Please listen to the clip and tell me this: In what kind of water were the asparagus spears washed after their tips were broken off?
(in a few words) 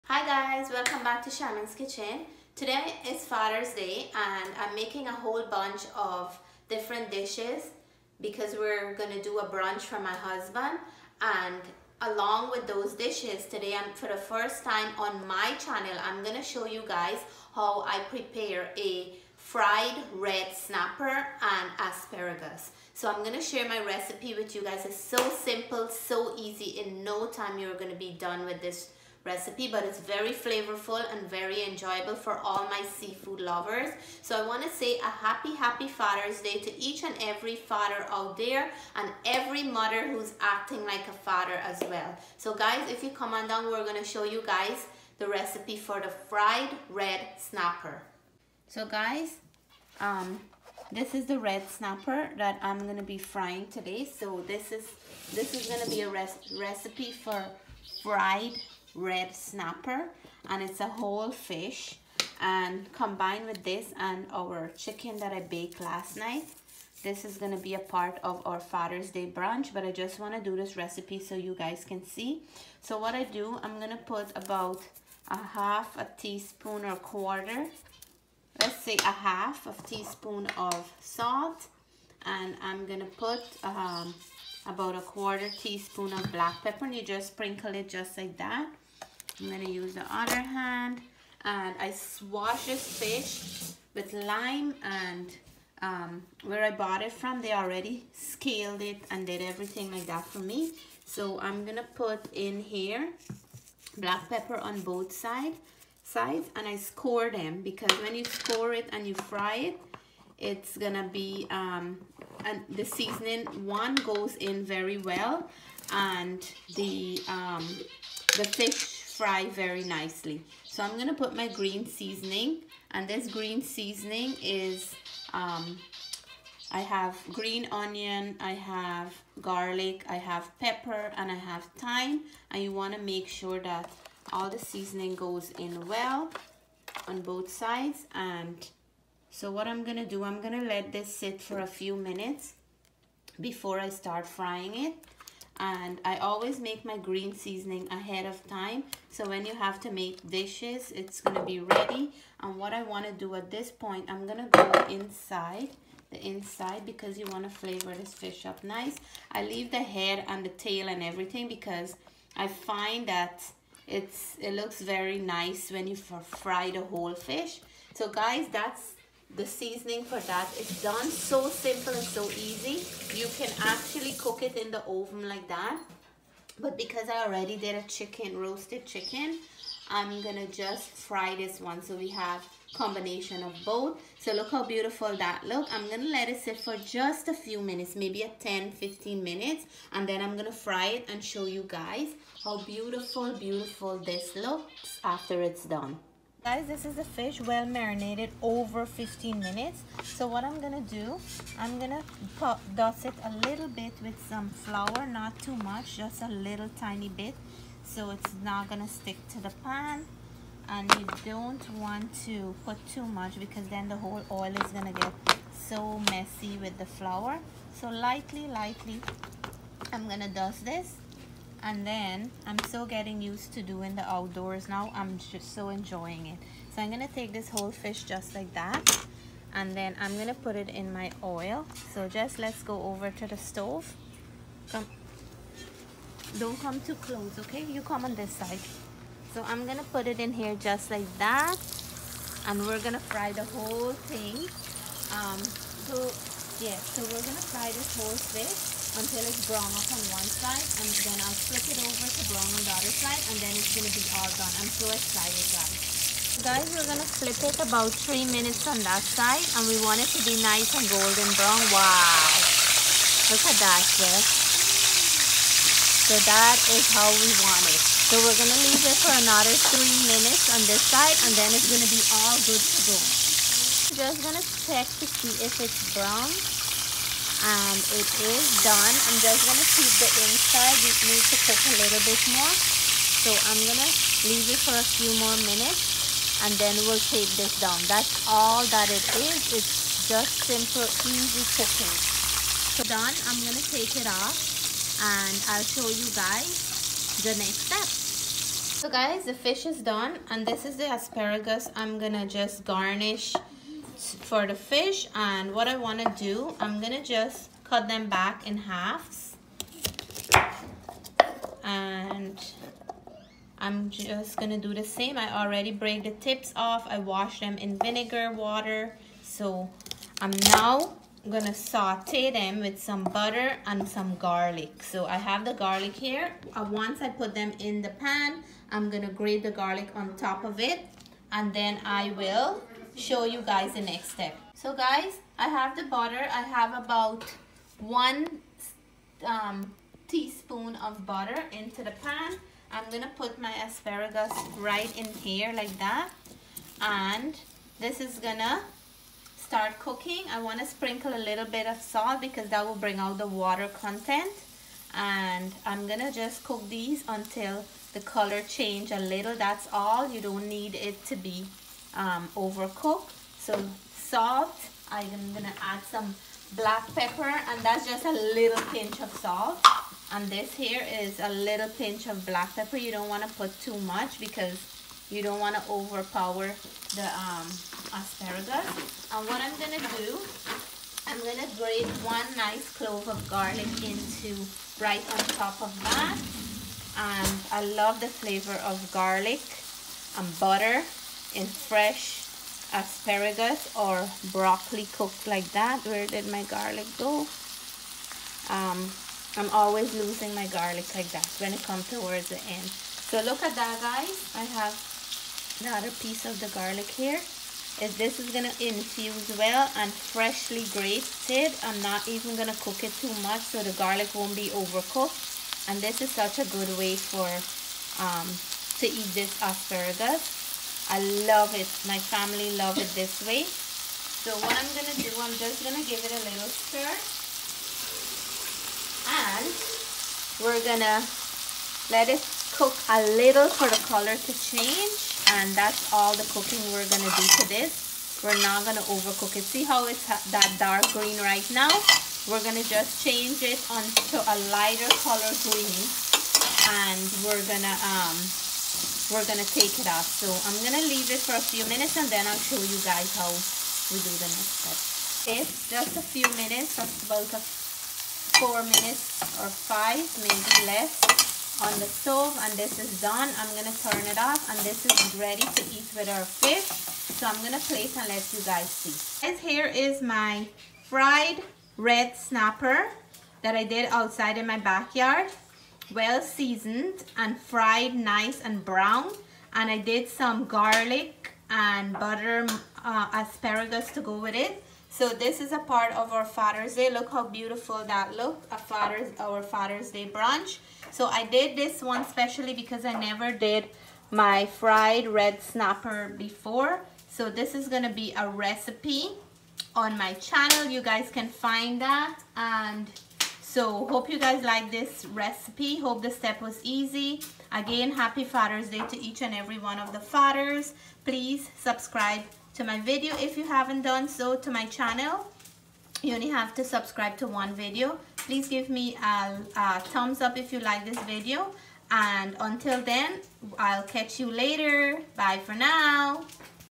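vinegar water.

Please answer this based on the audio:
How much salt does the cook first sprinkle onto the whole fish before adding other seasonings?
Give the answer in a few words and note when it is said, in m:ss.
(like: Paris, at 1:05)
half a teaspoon, at 1:18.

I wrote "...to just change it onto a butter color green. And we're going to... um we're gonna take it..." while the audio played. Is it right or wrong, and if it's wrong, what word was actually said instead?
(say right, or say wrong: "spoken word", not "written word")
wrong: "lighter", not "butter".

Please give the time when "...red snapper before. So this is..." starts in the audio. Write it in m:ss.
8:15.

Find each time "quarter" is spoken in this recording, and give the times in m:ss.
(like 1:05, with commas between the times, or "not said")
1:16, 1:25.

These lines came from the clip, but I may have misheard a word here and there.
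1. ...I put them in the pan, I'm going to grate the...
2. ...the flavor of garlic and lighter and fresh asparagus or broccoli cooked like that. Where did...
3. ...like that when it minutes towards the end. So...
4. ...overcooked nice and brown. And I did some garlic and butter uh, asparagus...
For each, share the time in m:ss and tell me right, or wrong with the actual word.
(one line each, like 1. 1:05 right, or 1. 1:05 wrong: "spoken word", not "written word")
1. 5:27 right
2. 6:28 wrong: "butter", not "lighter"
3. 6:40 wrong: "comes", not "minutes"
4. 7:57 wrong: "fried", not "overcooked".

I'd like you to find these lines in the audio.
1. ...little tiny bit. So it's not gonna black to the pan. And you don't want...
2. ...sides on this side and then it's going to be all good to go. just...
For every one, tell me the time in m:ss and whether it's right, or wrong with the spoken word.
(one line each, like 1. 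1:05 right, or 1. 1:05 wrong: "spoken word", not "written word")
1. 3:26 wrong: "stick", not "black"
2. 4:30 wrong: "minutes", not "sides".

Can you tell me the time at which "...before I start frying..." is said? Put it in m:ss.
2:23.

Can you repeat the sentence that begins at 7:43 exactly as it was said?
I'm gonna turn it off and this is ready to eat with our fish.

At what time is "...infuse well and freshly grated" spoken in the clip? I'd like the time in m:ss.
6:48.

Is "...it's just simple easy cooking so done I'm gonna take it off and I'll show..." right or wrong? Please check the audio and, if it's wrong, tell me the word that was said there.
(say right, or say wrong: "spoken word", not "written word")
right.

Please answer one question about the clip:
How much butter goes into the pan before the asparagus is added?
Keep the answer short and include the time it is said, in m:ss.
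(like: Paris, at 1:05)
1 teaspoon, at 5:37.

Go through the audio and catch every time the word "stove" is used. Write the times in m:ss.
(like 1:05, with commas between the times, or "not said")
3:53, 7:41.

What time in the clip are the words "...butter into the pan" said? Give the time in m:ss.
5:41.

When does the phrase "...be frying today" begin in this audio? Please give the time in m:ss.
0:53.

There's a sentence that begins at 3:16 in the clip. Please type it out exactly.
Guys, this is the fish well marinated over 15 minutes.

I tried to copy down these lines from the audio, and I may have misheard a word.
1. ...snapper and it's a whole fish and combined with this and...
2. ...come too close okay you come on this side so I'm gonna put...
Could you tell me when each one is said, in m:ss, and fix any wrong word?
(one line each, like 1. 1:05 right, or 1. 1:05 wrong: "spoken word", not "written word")
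1. 0:59 right
2. 3:56 right.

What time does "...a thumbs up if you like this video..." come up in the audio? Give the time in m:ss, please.
8:39.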